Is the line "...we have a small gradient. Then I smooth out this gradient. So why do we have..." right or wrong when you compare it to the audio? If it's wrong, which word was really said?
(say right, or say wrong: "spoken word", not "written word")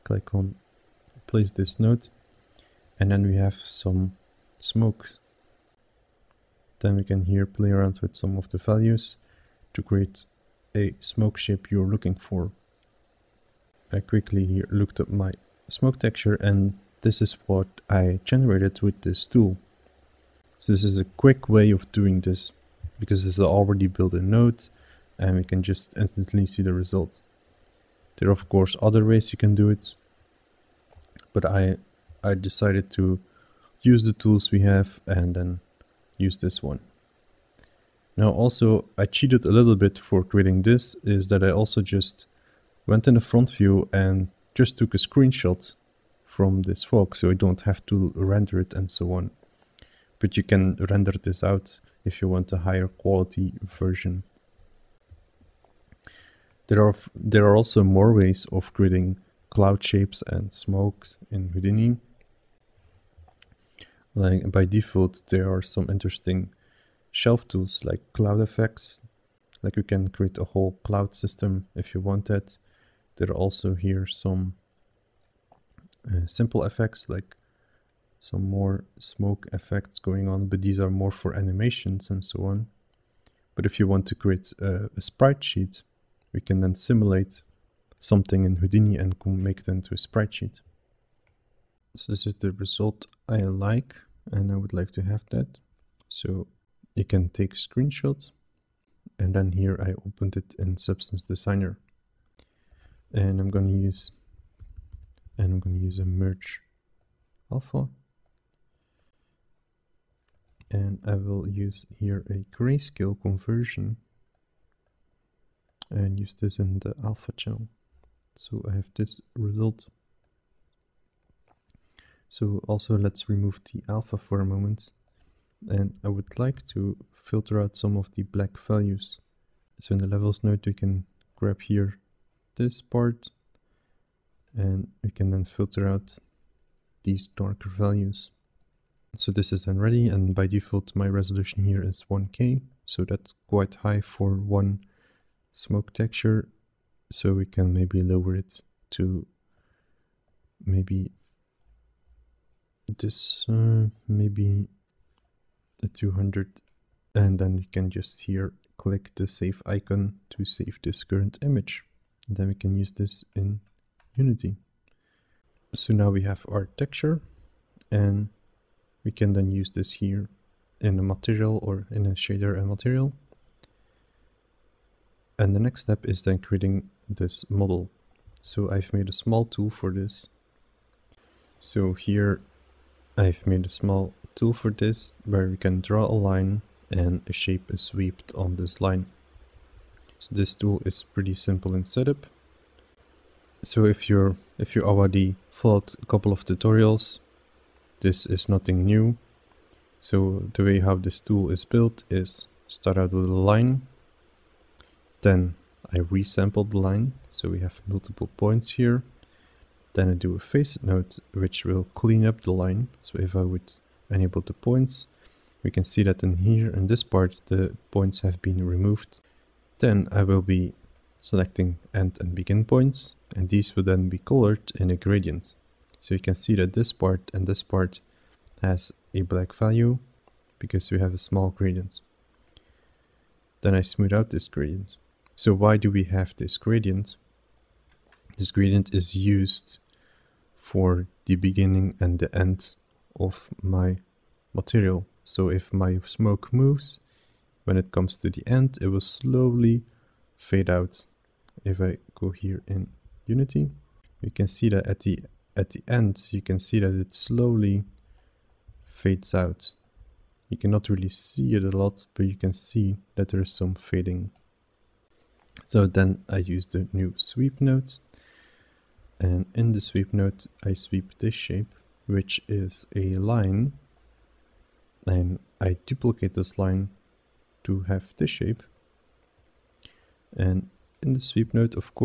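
right.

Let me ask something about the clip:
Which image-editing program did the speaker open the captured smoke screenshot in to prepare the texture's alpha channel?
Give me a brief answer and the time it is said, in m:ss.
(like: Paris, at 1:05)
Substance Designer, at 1:40.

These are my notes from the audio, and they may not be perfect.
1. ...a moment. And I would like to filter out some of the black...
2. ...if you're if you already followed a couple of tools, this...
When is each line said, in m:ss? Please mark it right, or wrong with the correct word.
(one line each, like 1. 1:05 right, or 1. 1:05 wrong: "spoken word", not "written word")
1. 2:04 right
2. 3:13 wrong: "tutorials", not "tools".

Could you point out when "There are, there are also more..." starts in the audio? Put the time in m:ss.
0:56.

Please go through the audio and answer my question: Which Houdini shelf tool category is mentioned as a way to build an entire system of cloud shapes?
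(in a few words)
cloud effects.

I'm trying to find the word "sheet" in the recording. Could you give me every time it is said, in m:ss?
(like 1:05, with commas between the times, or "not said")
1:25, 1:30.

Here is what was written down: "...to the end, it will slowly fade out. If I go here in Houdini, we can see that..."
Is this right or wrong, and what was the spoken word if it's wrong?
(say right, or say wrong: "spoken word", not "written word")
wrong: "Unity", not "Houdini".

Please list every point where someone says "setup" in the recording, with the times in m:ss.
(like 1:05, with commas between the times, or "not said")
3:11.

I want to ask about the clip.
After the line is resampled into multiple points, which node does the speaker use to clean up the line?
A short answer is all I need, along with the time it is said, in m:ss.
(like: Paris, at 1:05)
facet node, at 3:30.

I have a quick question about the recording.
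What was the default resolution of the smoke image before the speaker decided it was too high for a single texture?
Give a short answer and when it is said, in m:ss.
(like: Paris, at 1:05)
1K, at 2:22.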